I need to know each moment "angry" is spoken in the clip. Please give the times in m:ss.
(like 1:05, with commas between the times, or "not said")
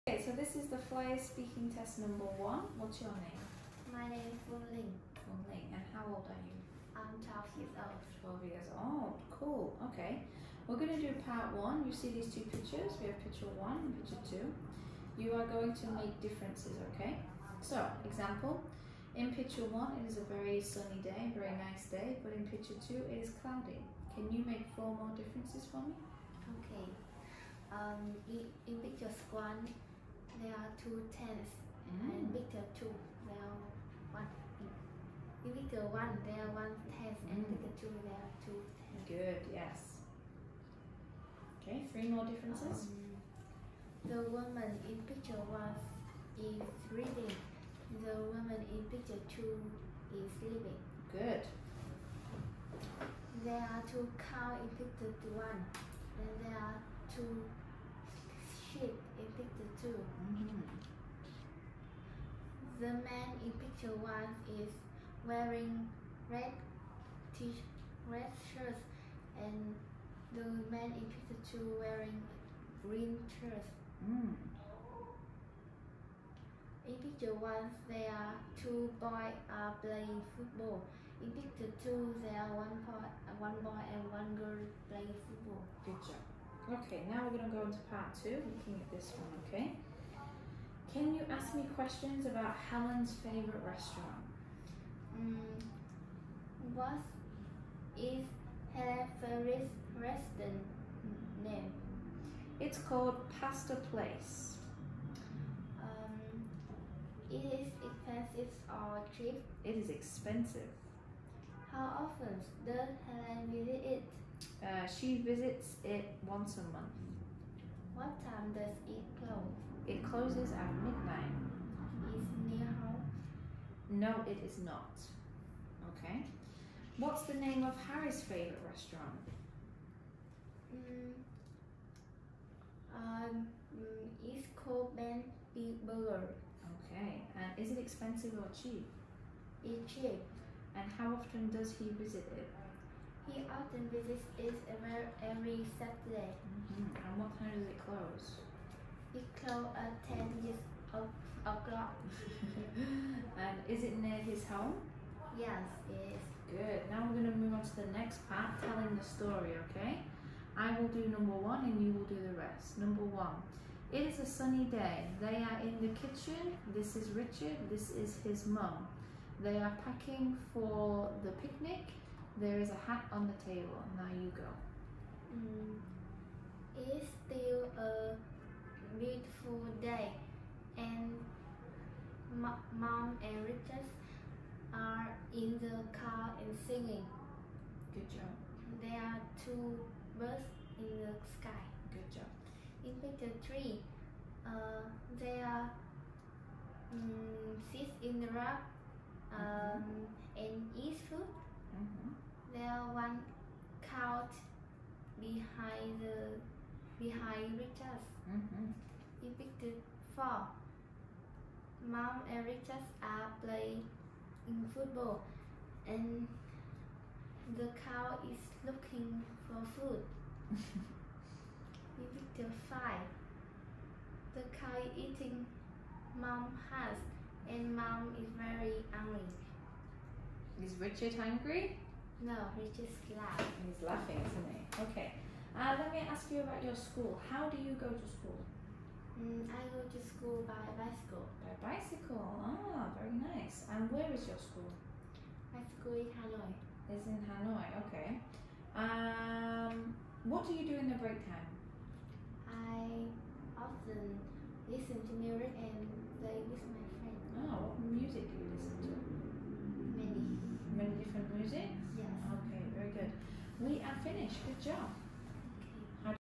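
3:48.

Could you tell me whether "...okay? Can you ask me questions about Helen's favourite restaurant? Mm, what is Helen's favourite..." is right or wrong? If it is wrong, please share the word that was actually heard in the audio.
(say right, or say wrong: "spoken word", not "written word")
right.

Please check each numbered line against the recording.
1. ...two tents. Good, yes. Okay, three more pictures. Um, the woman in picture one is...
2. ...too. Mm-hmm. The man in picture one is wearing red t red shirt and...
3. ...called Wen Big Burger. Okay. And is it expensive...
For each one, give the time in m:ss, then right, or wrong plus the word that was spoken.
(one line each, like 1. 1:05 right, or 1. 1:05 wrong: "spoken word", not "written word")
1. 0:38 wrong: "differences", not "pictures"
2. 0:59 right
3. 2:14 wrong: "Ben", not "Wen".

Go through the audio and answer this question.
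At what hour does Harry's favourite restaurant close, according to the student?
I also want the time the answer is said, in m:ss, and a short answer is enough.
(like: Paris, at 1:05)
10 o'clock, at 2:30.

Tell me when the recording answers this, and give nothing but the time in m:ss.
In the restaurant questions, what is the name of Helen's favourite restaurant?
1:43.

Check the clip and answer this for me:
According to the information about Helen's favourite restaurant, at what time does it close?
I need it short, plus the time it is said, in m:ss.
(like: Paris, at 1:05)
Midnight, at 2:00.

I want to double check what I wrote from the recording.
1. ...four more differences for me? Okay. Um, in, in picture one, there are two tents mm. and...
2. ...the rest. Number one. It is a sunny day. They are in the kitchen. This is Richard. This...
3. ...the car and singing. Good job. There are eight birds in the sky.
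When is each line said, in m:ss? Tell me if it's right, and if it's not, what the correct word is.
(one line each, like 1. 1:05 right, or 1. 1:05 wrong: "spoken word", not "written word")
1. 0:24 right
2. 2:42 right
3. 3:05 wrong: "two", not "eight".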